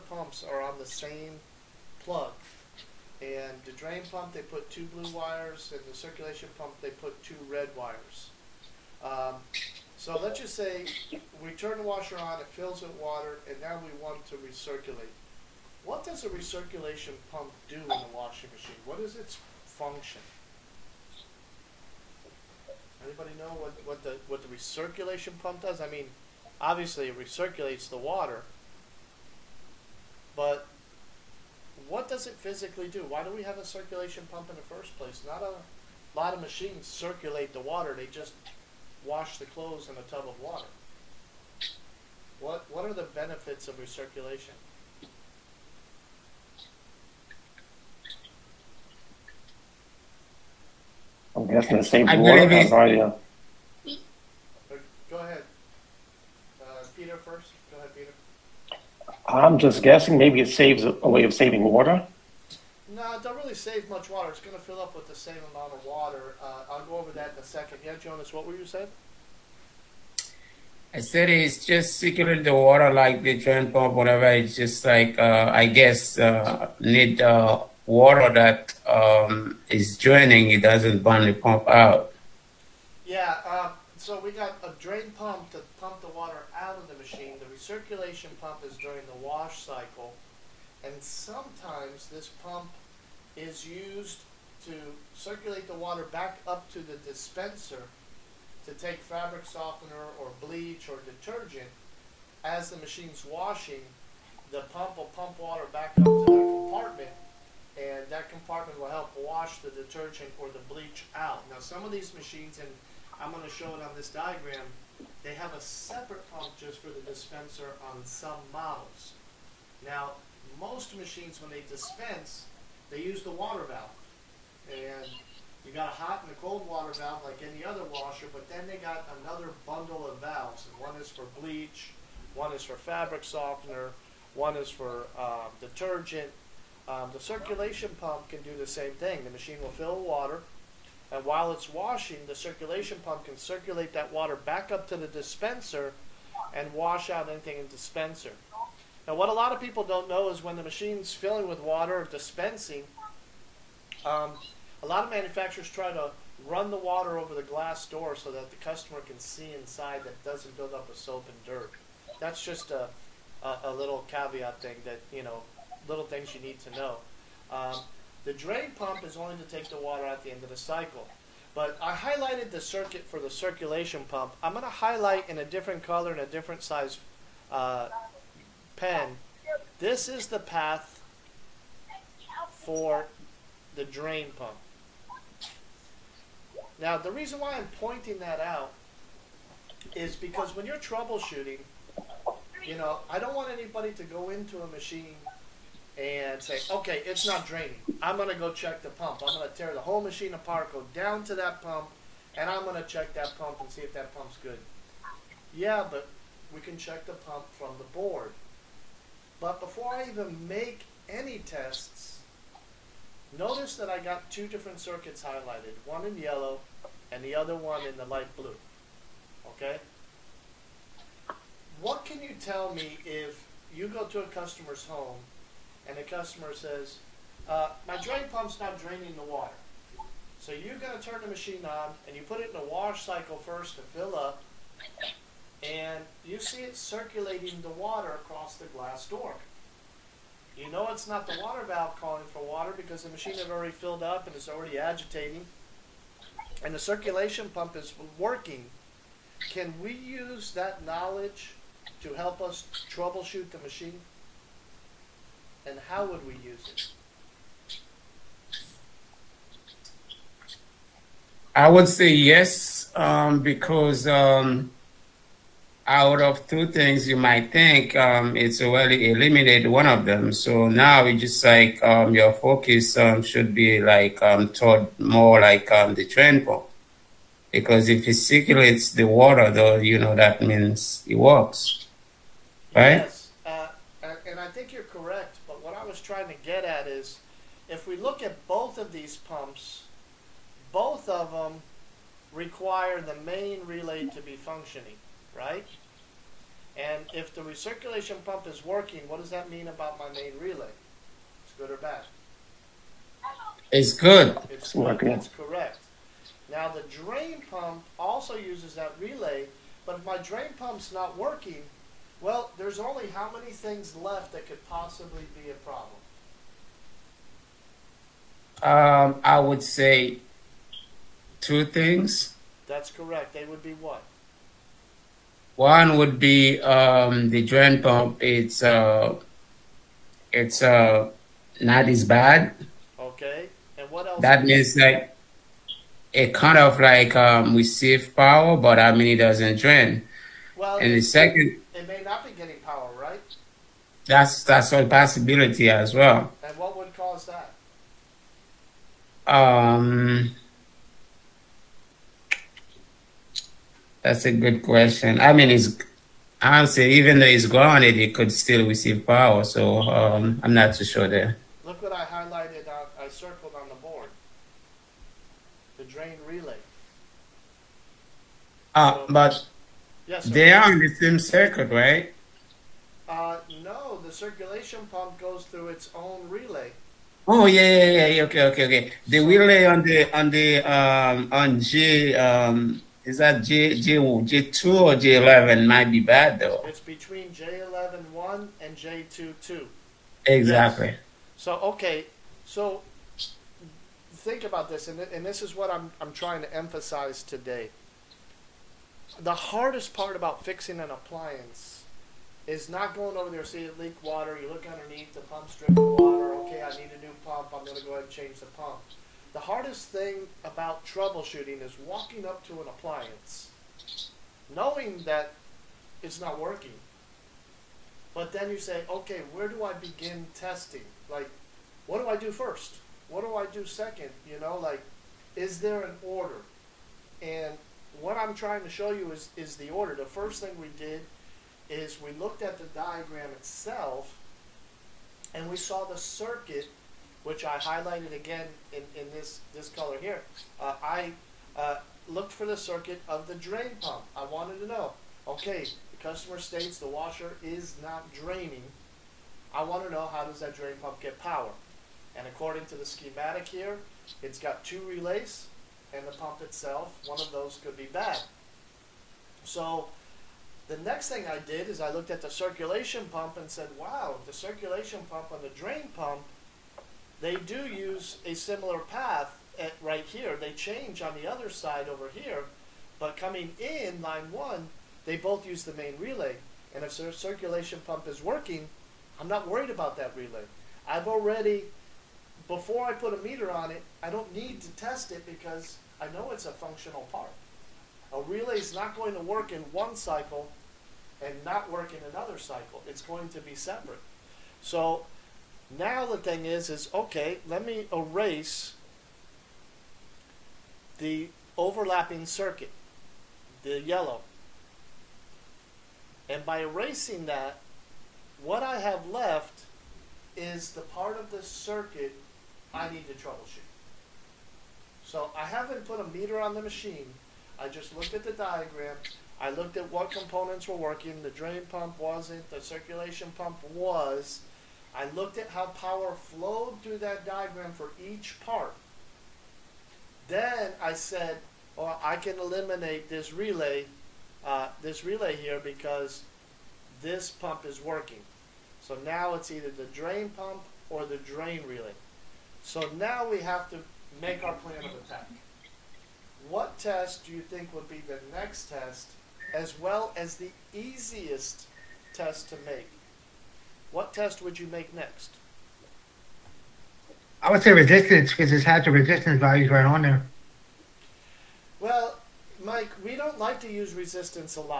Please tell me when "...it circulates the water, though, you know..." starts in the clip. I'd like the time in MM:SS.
04:38.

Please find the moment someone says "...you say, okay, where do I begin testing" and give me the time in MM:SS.
06:58.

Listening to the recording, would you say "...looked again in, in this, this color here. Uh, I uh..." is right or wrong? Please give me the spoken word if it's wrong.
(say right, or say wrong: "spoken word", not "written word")
wrong: "highlighted", not "looked".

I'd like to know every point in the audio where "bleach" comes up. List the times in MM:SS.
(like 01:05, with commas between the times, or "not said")
01:40, 01:50, 02:11.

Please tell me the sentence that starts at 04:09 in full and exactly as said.
Can we use that knowledge to help us troubleshoot the machine?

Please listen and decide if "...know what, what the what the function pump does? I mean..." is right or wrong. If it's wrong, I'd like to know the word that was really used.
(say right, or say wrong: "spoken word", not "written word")
wrong: "recirculation", not "function".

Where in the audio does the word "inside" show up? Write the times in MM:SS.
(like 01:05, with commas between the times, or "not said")
02:39.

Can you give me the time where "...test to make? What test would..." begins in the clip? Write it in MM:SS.
09:12.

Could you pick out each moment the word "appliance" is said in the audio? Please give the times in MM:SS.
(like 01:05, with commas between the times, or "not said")
06:40, 06:52.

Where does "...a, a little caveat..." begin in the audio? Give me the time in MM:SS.
02:43.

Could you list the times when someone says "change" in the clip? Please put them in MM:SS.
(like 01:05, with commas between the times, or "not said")
06:48, 07:50.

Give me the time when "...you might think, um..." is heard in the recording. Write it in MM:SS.
04:27.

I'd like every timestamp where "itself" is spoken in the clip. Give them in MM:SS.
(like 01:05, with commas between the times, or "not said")
07:13, 07:36.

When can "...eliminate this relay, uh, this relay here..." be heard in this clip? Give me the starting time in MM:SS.
08:52.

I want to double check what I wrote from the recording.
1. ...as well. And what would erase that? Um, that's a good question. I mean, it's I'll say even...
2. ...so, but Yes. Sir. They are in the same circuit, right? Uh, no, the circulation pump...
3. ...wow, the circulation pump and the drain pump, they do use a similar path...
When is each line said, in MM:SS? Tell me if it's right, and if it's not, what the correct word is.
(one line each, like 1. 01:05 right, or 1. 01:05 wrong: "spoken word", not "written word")
1. 05:45 wrong: "cause", not "erase"
2. 06:09 right
3. 07:43 right.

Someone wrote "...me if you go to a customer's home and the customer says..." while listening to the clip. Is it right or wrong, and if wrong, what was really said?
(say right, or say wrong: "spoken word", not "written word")
right.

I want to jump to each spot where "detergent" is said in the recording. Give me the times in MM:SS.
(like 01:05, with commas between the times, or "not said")
01:41, 01:49, 02:15.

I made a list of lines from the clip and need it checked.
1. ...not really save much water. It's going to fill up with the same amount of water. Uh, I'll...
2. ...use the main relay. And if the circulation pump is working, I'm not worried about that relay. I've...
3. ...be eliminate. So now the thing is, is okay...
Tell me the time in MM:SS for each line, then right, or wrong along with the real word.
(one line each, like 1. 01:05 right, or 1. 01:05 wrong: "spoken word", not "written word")
1. 01:03 right
2. 07:55 right
3. 08:13 wrong: "separate", not "eliminate".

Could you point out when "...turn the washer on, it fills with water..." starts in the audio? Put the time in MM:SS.
00:11.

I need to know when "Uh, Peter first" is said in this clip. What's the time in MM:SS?
00:56.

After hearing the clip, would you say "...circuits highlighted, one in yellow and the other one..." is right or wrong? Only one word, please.
right.